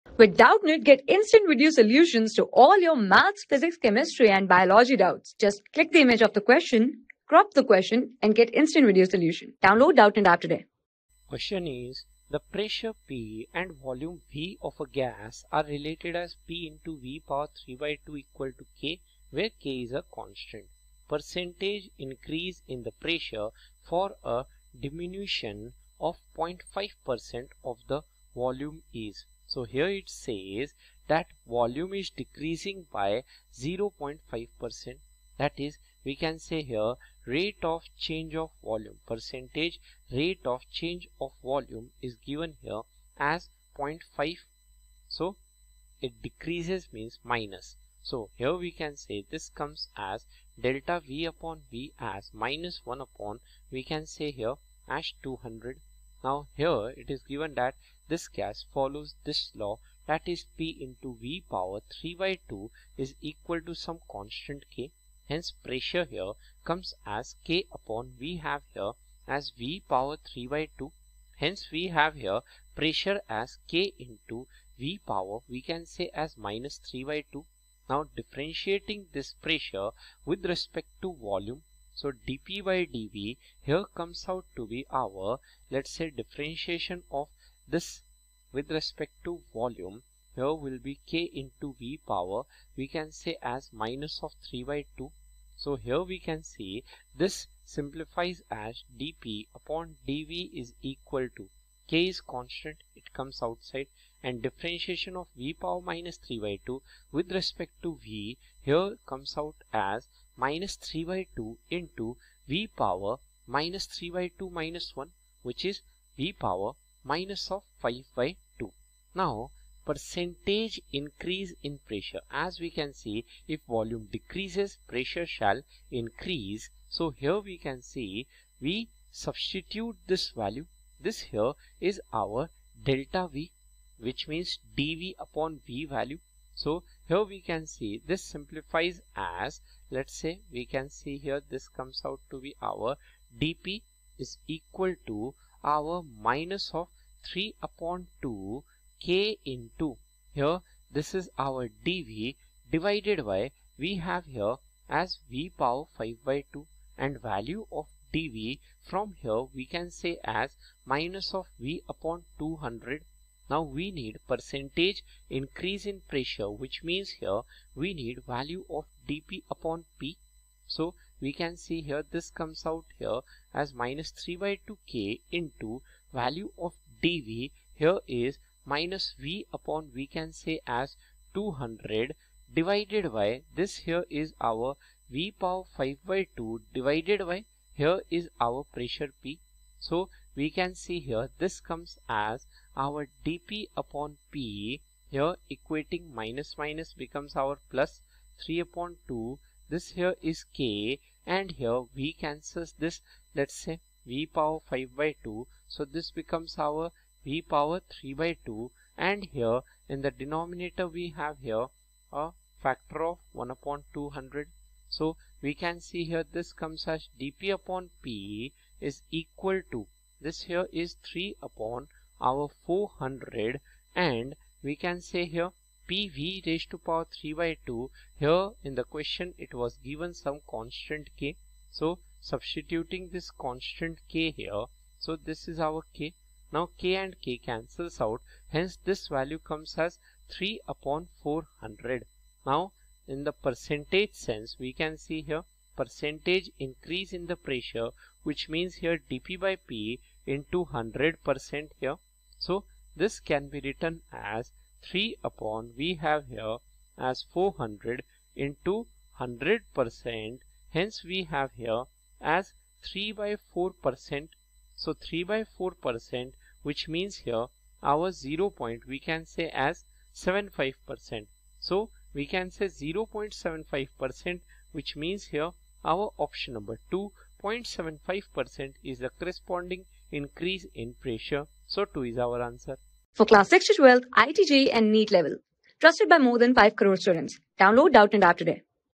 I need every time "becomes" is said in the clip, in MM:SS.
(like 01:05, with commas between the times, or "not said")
03:16, 03:26.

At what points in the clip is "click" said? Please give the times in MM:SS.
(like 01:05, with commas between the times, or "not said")
00:05.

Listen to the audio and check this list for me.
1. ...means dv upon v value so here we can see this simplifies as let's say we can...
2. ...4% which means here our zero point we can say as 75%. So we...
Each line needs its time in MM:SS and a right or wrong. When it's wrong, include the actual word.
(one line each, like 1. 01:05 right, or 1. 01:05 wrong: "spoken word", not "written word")
1. 02:14 right
2. 04:25 right.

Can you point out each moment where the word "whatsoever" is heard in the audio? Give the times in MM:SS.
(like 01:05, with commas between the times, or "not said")
not said.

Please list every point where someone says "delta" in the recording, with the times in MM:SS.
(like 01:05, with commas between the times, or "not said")
00:50, 02:12.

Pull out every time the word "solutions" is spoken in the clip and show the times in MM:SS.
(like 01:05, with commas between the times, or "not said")
00:01, 00:09.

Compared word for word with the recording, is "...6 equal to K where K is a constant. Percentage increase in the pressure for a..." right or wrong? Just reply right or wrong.
wrong.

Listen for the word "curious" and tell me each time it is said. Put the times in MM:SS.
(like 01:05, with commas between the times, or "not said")
not said.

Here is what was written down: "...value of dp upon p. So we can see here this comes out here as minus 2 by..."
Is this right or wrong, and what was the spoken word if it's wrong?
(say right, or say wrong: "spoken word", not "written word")
wrong: "3", not "2".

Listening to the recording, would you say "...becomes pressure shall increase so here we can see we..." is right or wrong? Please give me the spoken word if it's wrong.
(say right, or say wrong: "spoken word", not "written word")
wrong: "decreases", not "becomes".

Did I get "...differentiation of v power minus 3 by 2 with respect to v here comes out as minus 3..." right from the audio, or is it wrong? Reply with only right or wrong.
right.